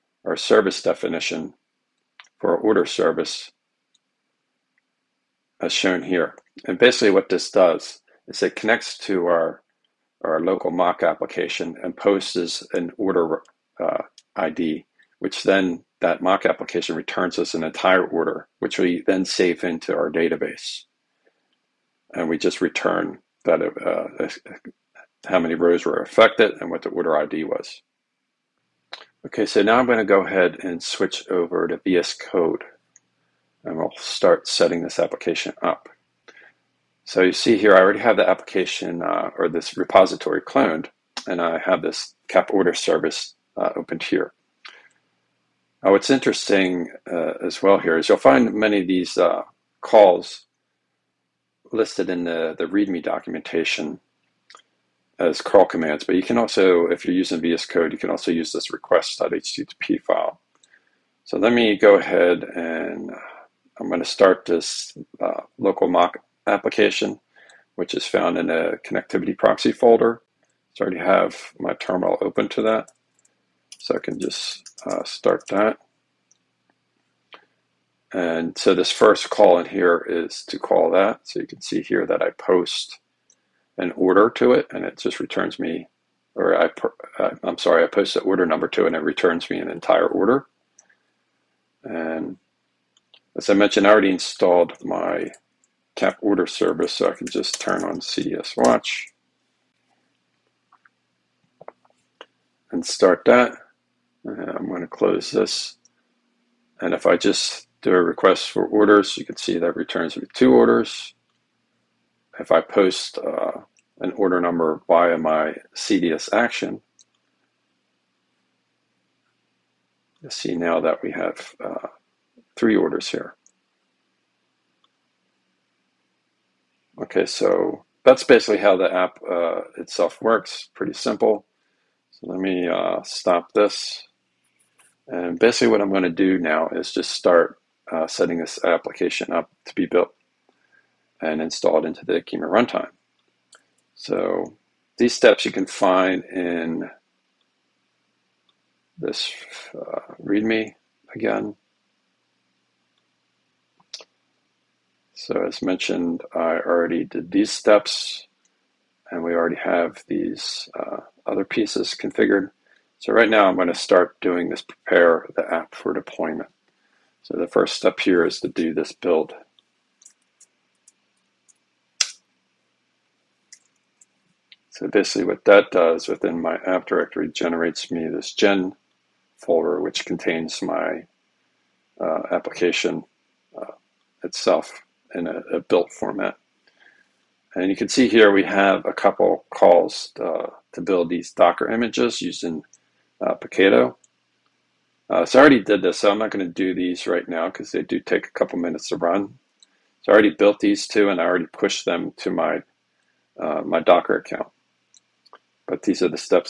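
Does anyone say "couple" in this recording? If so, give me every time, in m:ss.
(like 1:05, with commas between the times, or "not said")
3:08, 3:18.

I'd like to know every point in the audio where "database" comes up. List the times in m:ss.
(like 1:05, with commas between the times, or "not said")
0:20.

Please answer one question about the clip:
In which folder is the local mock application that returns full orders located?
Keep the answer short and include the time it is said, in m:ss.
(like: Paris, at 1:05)
connectivity proxy, at 1:08.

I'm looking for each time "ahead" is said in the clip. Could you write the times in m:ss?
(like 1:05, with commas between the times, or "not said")
0:30, 1:01.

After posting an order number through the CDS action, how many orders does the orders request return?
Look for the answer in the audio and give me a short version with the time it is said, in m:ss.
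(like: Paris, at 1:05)
3, at 2:02.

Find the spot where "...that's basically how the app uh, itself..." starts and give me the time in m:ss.
2:08.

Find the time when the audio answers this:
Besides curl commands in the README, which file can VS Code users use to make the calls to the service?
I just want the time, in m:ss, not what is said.
0:58.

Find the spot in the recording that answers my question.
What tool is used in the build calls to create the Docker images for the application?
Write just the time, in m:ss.
3:13.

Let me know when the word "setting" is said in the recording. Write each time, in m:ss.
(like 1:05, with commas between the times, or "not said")
0:34, 2:18.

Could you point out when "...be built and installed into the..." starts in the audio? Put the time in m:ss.
2:19.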